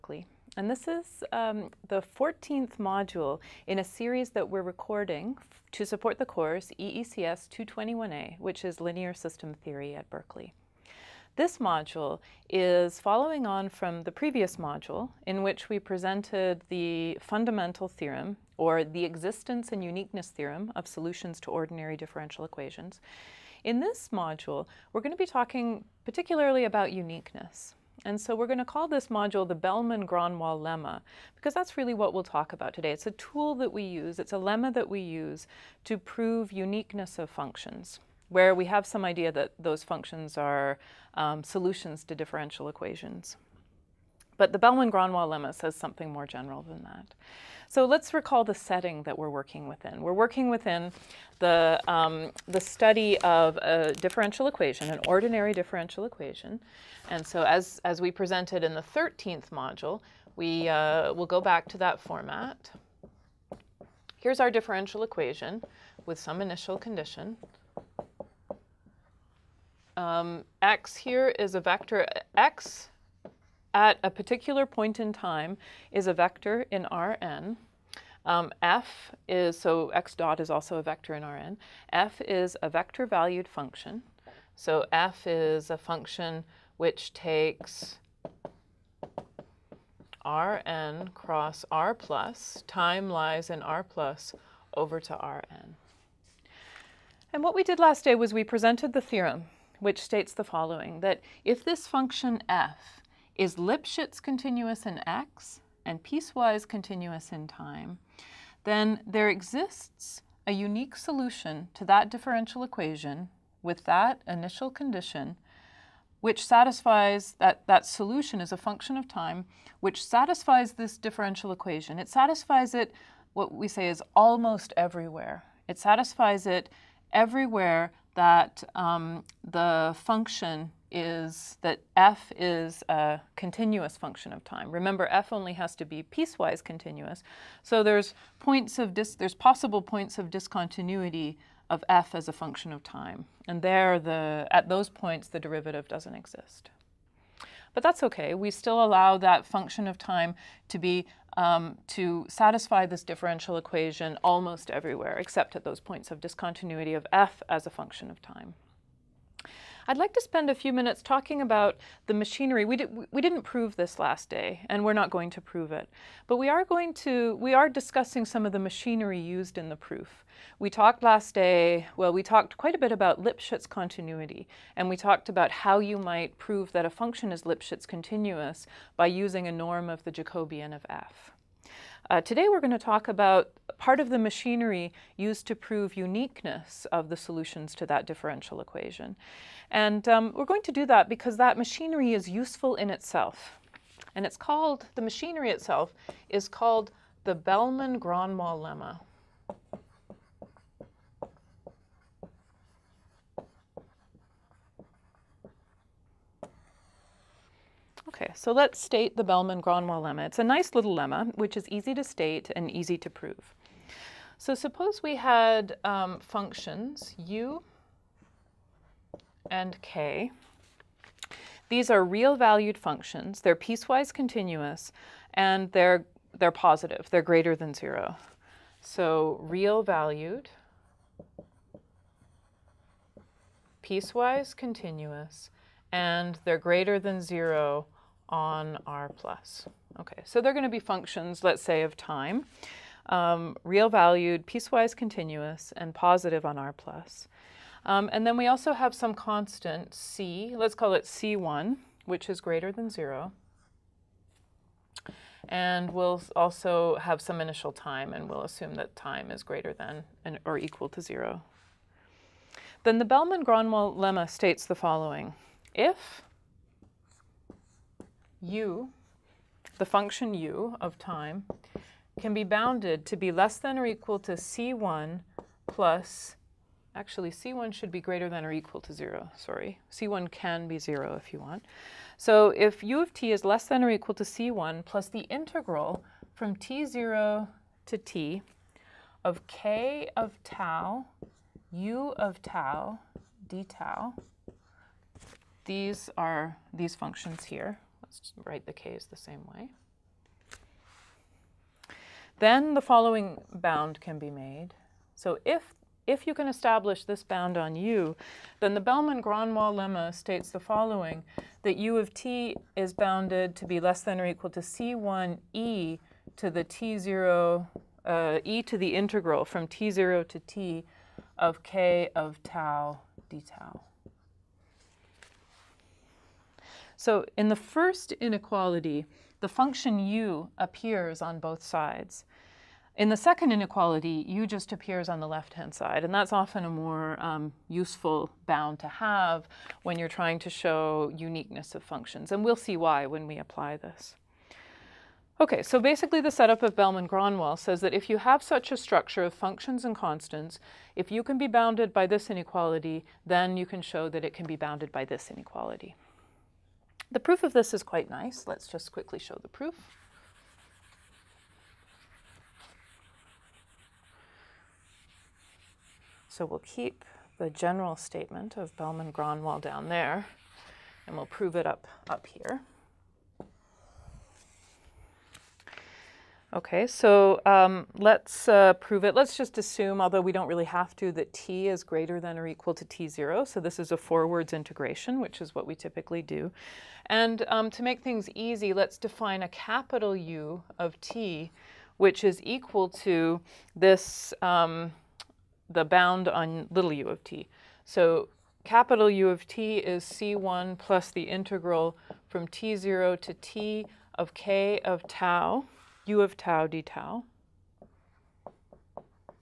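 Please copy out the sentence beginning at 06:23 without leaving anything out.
So this is a forwards integration, which is what we typically do.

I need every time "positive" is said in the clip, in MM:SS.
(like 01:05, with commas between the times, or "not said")
03:46, 04:05.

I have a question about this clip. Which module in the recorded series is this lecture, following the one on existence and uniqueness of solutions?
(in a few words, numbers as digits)
14th.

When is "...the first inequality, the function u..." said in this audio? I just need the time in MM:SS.
05:27.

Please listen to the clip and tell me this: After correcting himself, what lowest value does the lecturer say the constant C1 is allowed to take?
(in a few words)
0.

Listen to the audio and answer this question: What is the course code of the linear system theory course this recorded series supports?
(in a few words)
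EECS 221A.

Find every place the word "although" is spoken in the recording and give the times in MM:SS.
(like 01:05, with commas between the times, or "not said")
06:20.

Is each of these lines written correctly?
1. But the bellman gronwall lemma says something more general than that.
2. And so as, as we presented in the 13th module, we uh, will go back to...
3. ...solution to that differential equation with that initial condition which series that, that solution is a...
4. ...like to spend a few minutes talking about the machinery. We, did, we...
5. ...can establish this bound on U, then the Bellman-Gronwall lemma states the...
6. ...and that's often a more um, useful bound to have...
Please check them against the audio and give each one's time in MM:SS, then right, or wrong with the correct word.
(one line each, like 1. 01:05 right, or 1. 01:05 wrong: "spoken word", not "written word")
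1. 00:44 right
2. 00:57 right
3. 01:50 wrong: "satisfies", not "series"
4. 02:39 right
5. 05:06 right
6. 05:36 right.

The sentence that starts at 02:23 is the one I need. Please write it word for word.
And there, the, at those points, the derivative doesn't exist.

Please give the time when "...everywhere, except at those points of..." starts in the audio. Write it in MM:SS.
02:34.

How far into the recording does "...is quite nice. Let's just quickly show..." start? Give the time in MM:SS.
05:57.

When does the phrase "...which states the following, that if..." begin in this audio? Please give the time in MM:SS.
01:39.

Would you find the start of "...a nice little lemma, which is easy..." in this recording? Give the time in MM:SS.
03:30.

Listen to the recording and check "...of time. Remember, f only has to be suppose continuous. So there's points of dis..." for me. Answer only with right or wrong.
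wrong.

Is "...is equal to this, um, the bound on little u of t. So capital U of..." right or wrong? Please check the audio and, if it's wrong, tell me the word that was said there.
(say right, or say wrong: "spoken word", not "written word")
right.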